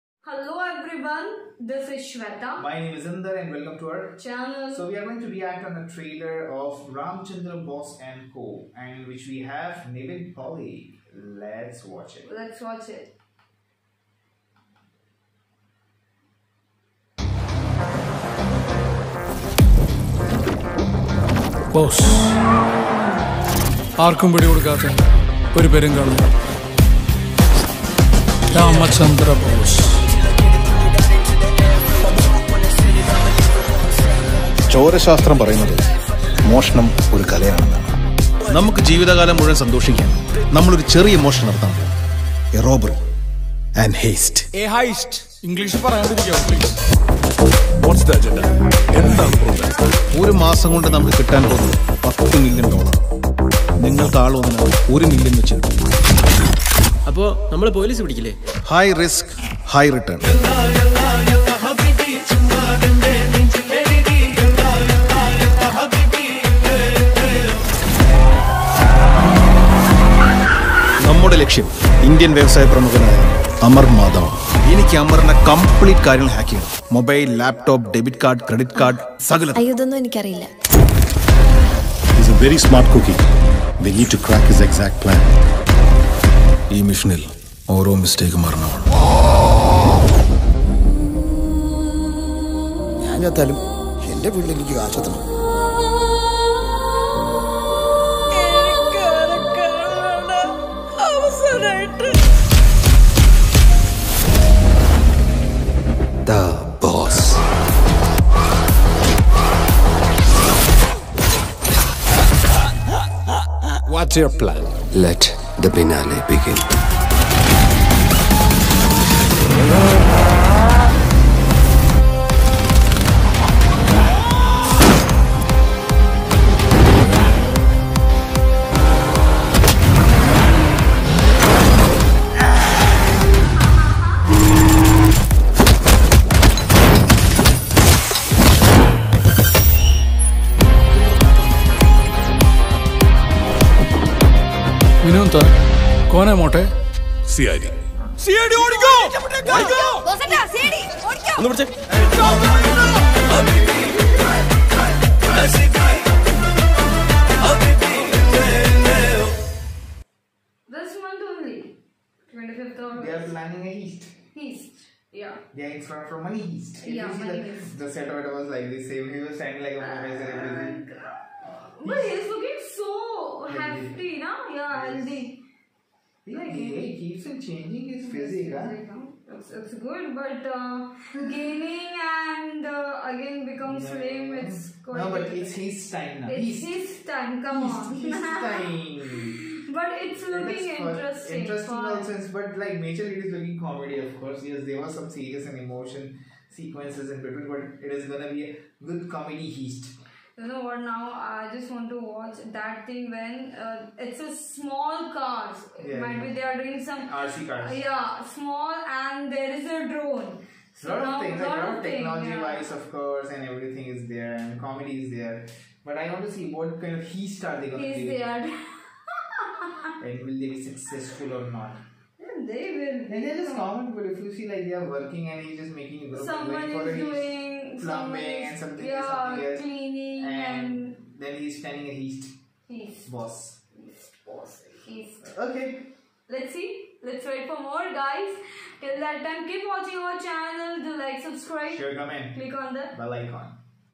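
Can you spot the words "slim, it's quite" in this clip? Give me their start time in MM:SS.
03:03.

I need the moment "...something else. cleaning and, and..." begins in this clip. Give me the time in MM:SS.
03:49.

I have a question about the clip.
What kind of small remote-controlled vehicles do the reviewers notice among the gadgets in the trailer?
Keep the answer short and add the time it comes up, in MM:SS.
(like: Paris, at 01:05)
RC cars, at 03:27.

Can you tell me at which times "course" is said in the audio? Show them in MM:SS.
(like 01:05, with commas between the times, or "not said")
03:14, 03:32.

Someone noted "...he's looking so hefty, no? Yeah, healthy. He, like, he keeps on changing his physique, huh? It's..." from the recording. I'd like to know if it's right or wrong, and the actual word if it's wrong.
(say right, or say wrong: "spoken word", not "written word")
right.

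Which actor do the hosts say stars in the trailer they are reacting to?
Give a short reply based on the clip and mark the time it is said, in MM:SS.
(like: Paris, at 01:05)
Nivin Pauly, at 00:09.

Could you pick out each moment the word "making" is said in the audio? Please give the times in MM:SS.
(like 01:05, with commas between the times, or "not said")
03:45.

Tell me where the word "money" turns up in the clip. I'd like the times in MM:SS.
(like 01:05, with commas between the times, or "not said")
02:47.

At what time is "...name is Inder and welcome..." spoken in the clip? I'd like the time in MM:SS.
00:02.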